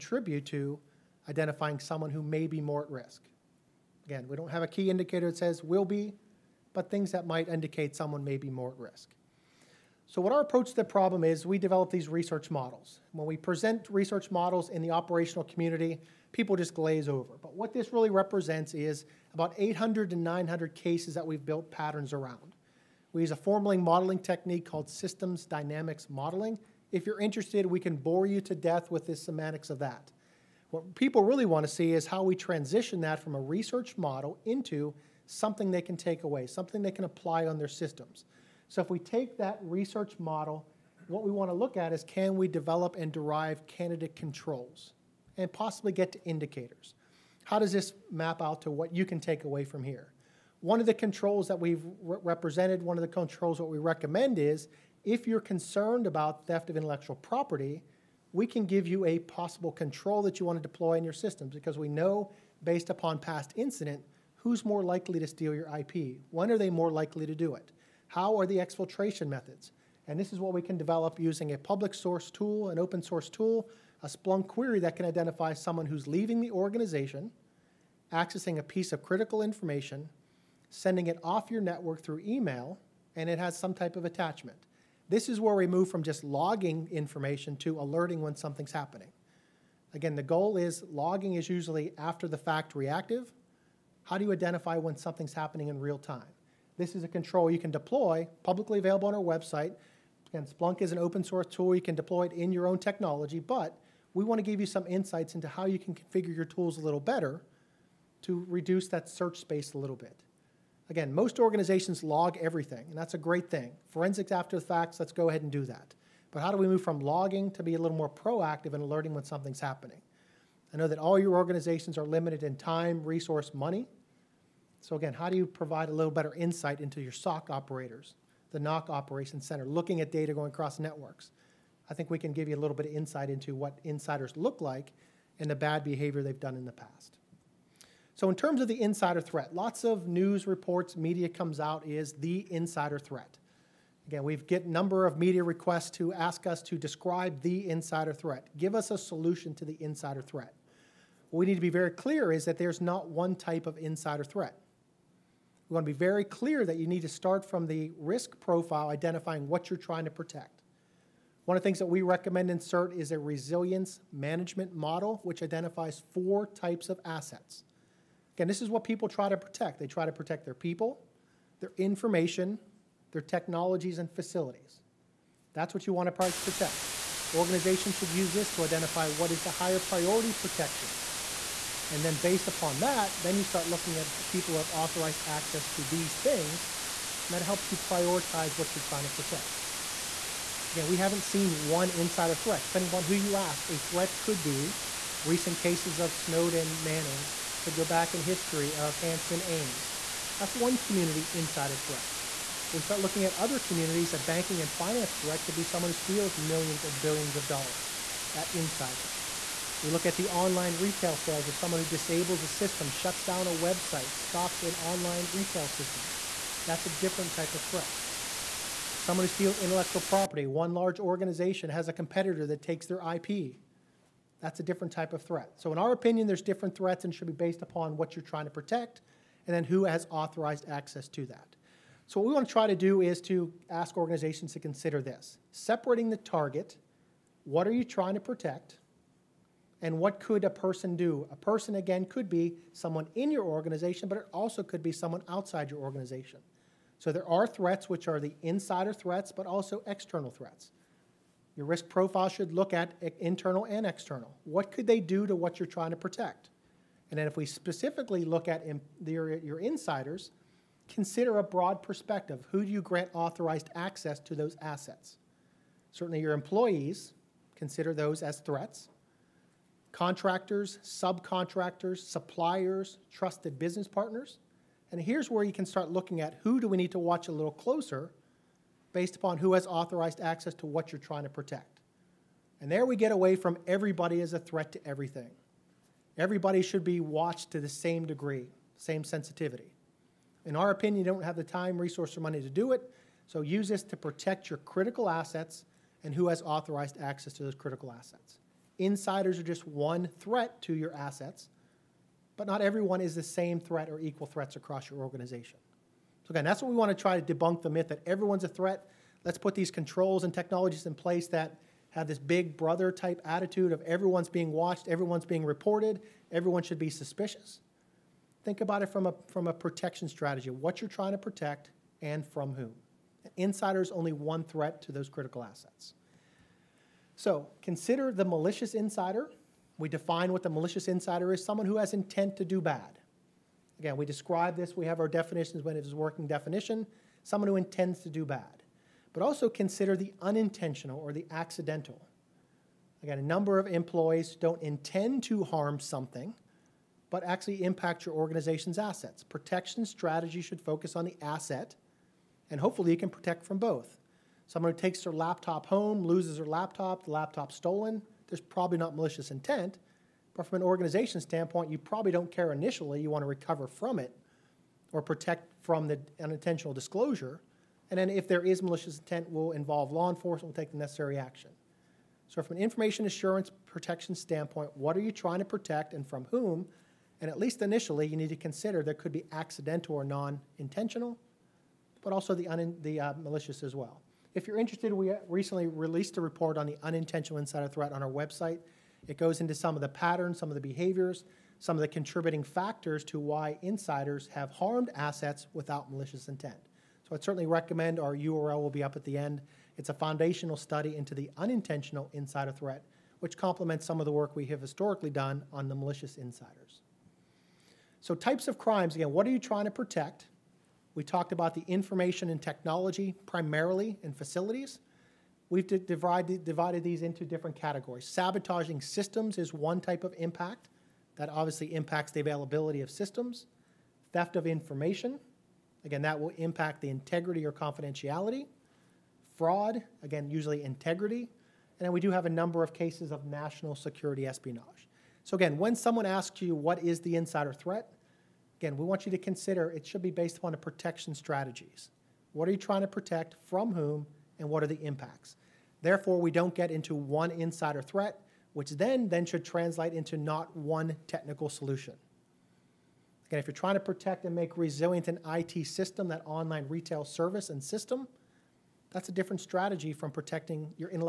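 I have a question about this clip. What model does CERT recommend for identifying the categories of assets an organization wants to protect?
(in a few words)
resilience management model.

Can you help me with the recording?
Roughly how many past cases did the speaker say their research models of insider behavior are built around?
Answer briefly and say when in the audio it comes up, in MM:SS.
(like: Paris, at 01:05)
800 to 900, at 00:19.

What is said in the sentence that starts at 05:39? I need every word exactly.
But also consider the unintentional or the accidental.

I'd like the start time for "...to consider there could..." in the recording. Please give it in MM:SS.
06:18.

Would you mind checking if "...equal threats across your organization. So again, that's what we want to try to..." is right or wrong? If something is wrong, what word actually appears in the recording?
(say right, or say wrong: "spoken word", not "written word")
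right.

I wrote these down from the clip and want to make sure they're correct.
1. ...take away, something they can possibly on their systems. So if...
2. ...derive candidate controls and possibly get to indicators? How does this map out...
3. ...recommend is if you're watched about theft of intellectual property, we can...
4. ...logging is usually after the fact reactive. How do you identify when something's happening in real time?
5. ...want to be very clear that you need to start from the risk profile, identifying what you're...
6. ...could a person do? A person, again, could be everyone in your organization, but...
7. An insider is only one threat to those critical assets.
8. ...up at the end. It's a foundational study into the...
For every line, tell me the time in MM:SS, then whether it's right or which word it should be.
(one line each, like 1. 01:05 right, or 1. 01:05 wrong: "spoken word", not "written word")
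1. 00:35 wrong: "apply", not "possibly"
2. 00:43 right
3. 00:53 wrong: "concerned", not "watched"
4. 01:30 right
5. 02:35 right
6. 04:00 wrong: "someone", not "everyone"
7. 05:23 right
8. 06:38 right.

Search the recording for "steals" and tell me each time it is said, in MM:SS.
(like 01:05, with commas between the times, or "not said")
01:05, 03:25, 03:39.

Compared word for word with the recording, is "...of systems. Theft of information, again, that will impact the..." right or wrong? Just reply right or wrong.
right.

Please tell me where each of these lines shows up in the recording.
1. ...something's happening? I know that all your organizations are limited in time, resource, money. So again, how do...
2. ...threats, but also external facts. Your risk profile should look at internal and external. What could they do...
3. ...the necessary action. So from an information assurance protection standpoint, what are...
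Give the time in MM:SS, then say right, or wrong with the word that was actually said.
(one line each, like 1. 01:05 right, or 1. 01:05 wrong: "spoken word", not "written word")
1. 01:59 right
2. 04:08 wrong: "threats", not "facts"
3. 06:10 right.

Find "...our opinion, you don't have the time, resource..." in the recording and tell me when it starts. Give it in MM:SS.
04:50.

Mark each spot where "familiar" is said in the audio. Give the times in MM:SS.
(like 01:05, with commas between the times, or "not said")
not said.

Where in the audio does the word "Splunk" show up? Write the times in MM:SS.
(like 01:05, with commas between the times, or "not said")
01:14, 01:40.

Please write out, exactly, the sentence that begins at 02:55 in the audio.
That's what you want to protect.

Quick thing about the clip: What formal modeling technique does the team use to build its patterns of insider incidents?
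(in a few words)
systems dynamics modeling.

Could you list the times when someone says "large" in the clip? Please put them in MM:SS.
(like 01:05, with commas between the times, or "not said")
03:40.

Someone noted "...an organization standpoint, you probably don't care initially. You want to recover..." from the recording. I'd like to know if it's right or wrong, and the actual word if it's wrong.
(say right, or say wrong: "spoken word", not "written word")
right.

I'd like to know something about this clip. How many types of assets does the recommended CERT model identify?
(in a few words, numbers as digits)
4.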